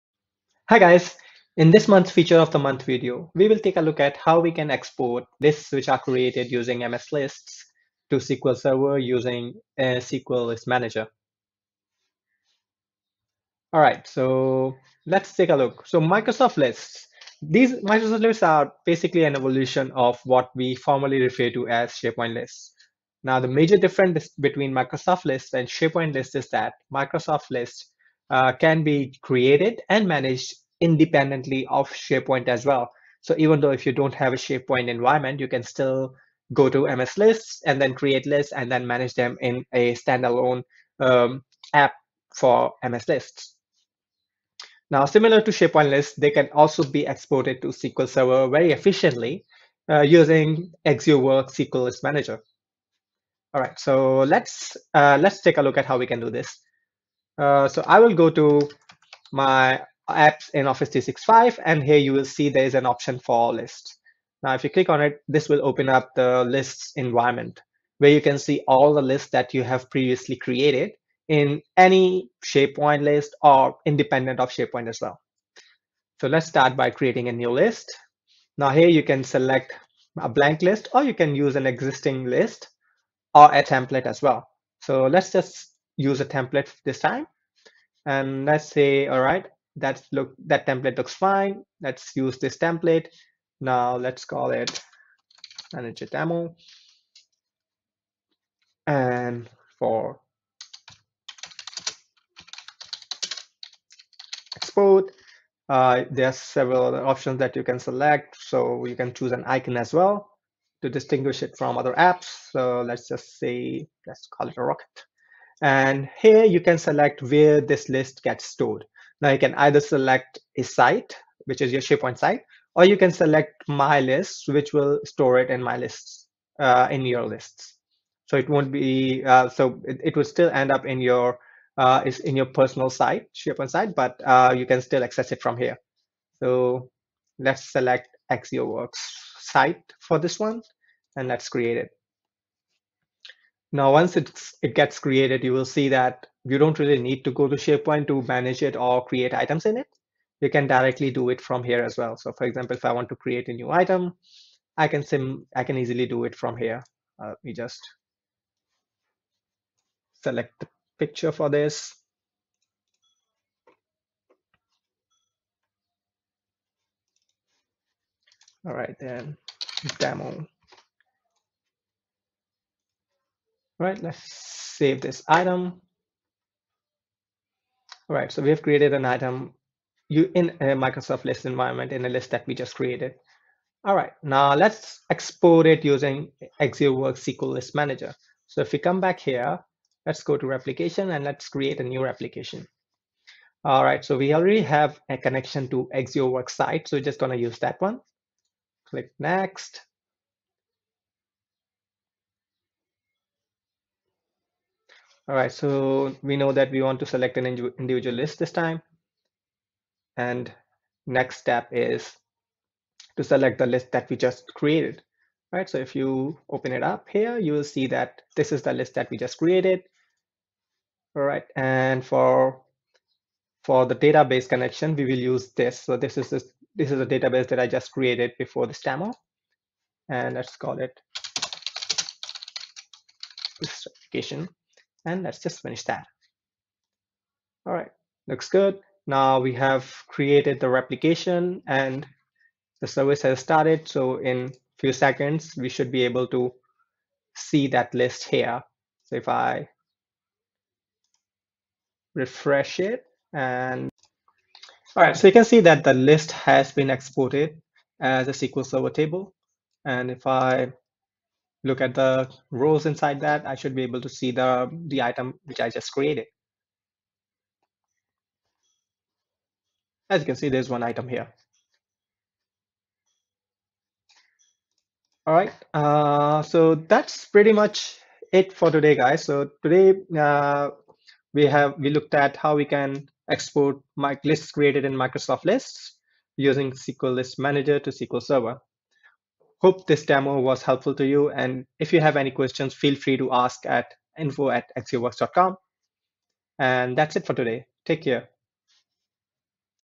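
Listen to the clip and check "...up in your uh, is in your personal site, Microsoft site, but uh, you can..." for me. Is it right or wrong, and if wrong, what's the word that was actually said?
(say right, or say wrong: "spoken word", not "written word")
wrong: "SharePoint", not "Microsoft".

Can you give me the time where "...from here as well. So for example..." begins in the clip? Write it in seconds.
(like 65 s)
151 s.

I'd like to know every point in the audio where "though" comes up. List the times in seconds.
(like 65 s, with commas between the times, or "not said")
33 s.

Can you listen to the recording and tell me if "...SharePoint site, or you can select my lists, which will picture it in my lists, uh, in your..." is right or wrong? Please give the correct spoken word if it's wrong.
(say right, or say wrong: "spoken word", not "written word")
wrong: "store", not "picture".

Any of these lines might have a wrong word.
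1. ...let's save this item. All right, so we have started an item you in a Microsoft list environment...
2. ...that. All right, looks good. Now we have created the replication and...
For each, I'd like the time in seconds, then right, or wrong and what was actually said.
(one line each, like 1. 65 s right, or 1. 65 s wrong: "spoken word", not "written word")
1. 174 s wrong: "created", not "started"
2. 235 s right.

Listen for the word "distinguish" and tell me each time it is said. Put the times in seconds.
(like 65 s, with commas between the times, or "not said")
110 s.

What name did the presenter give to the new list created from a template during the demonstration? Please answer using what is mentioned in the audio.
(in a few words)
manager demo.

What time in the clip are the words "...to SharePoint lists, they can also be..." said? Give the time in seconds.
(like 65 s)
45 s.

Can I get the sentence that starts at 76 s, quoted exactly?
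So let's start by creating a new list.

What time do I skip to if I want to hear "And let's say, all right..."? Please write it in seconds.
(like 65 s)
88 s.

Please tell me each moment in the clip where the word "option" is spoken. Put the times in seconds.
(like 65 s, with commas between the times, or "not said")
62 s, 107 s.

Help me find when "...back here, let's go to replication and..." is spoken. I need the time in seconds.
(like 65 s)
189 s.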